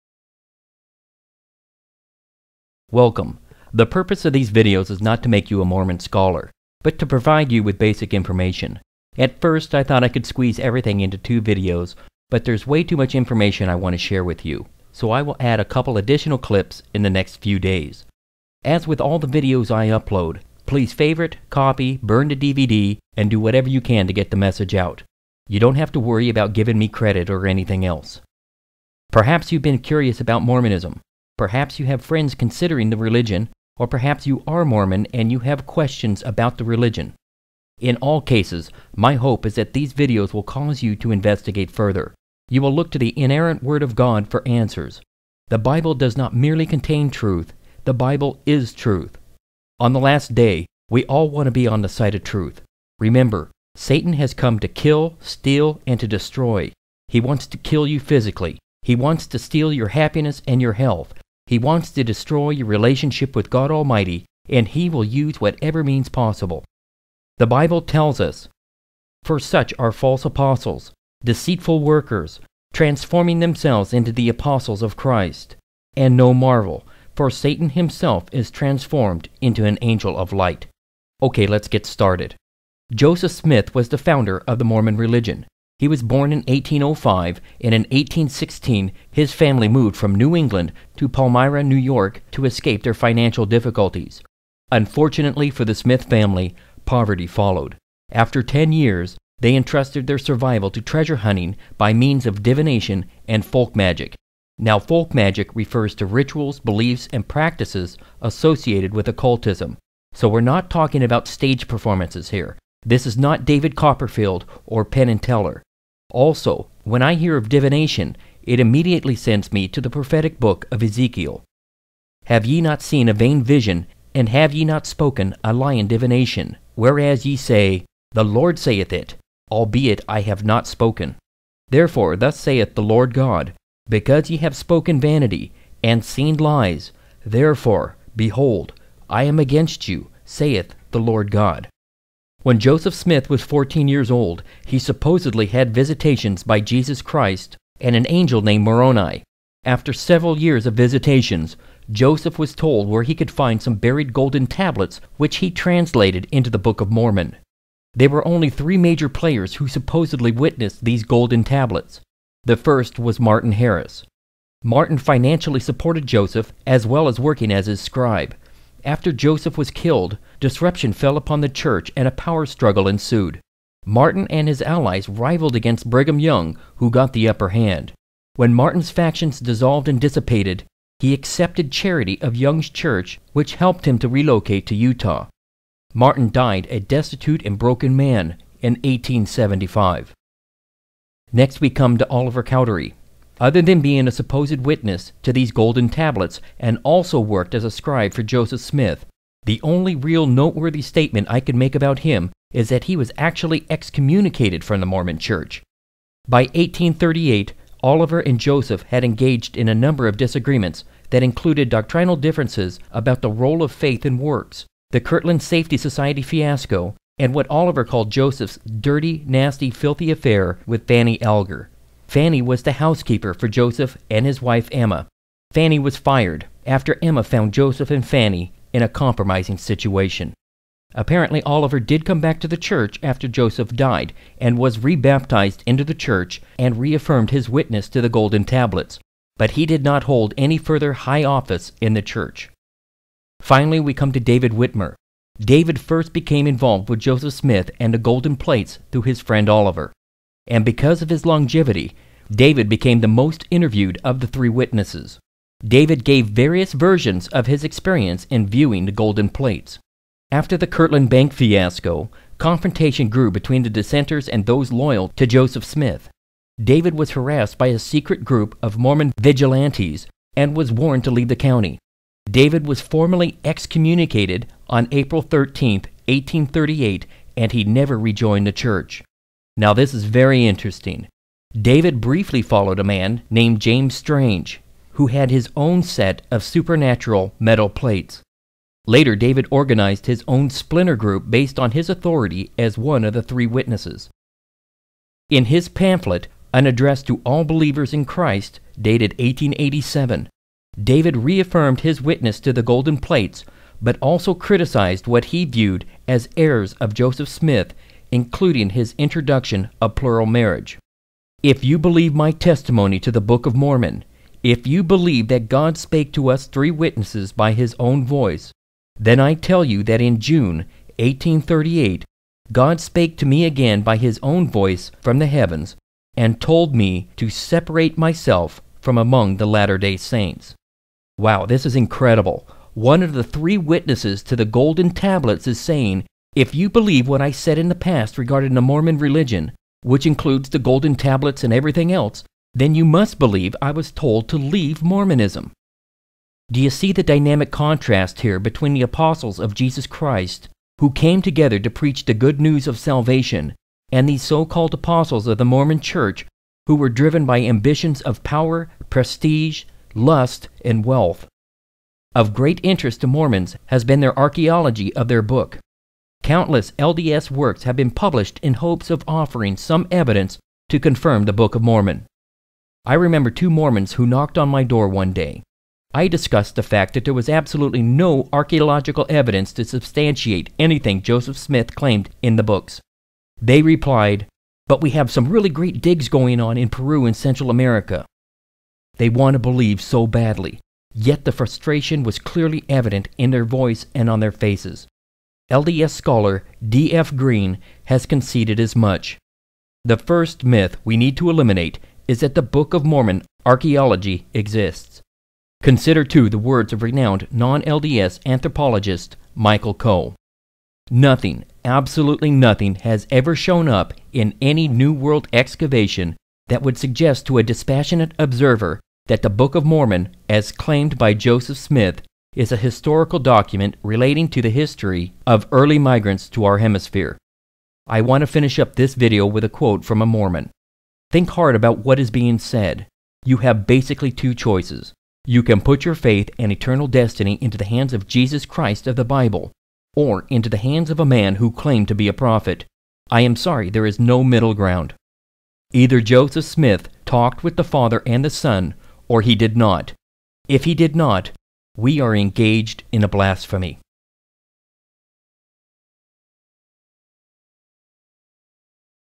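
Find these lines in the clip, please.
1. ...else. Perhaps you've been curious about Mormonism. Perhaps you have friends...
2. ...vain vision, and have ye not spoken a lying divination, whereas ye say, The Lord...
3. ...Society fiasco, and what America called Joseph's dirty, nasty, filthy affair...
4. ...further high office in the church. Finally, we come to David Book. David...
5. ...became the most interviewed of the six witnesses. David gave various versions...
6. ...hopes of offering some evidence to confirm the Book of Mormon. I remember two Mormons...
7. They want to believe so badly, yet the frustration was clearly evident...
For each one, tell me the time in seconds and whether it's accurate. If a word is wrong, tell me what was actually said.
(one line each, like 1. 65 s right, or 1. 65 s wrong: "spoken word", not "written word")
1. 27 s right
2. 123 s right
3. 215 s wrong: "Oliver", not "America"
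4. 240 s wrong: "Whitmer", not "Book"
5. 252 s wrong: "three", not "six"
6. 368 s right
7. 388 s right.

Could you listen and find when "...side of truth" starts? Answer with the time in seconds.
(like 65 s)
51 s.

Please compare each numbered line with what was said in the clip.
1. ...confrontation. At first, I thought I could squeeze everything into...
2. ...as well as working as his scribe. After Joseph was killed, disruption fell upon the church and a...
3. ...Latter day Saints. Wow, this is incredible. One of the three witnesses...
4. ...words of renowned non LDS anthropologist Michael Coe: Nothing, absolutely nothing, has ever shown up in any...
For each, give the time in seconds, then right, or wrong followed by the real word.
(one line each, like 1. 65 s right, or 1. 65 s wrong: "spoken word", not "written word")
1. 8 s wrong: "information", not "confrontation"
2. 166 s right
3. 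329 s right
4. 406 s right.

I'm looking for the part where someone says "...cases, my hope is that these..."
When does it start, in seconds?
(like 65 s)
38 s.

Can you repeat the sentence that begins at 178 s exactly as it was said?
When Martin's factions dissolved and dissipated, he accepted charity of Young's church, which helped him to relocate to Utah.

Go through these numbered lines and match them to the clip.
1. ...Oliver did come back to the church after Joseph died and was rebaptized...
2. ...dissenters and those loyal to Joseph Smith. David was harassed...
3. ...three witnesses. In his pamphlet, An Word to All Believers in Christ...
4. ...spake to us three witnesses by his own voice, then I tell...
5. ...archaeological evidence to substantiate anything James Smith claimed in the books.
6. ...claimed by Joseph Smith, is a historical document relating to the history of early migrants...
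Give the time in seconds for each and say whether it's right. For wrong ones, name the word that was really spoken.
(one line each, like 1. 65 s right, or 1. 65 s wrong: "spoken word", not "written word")
1. 231 s right
2. 263 s right
3. 293 s wrong: "Address", not "Word"
4. 315 s right
5. 378 s wrong: "Joseph", not "James"
6. 420 s right.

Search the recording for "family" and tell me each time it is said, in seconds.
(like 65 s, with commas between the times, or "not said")
89 s, 96 s.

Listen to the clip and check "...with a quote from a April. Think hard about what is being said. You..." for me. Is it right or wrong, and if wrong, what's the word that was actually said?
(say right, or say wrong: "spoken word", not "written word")
wrong: "Mormon", not "April".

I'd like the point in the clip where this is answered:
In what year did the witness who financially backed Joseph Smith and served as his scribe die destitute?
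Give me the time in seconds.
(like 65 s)
188 s.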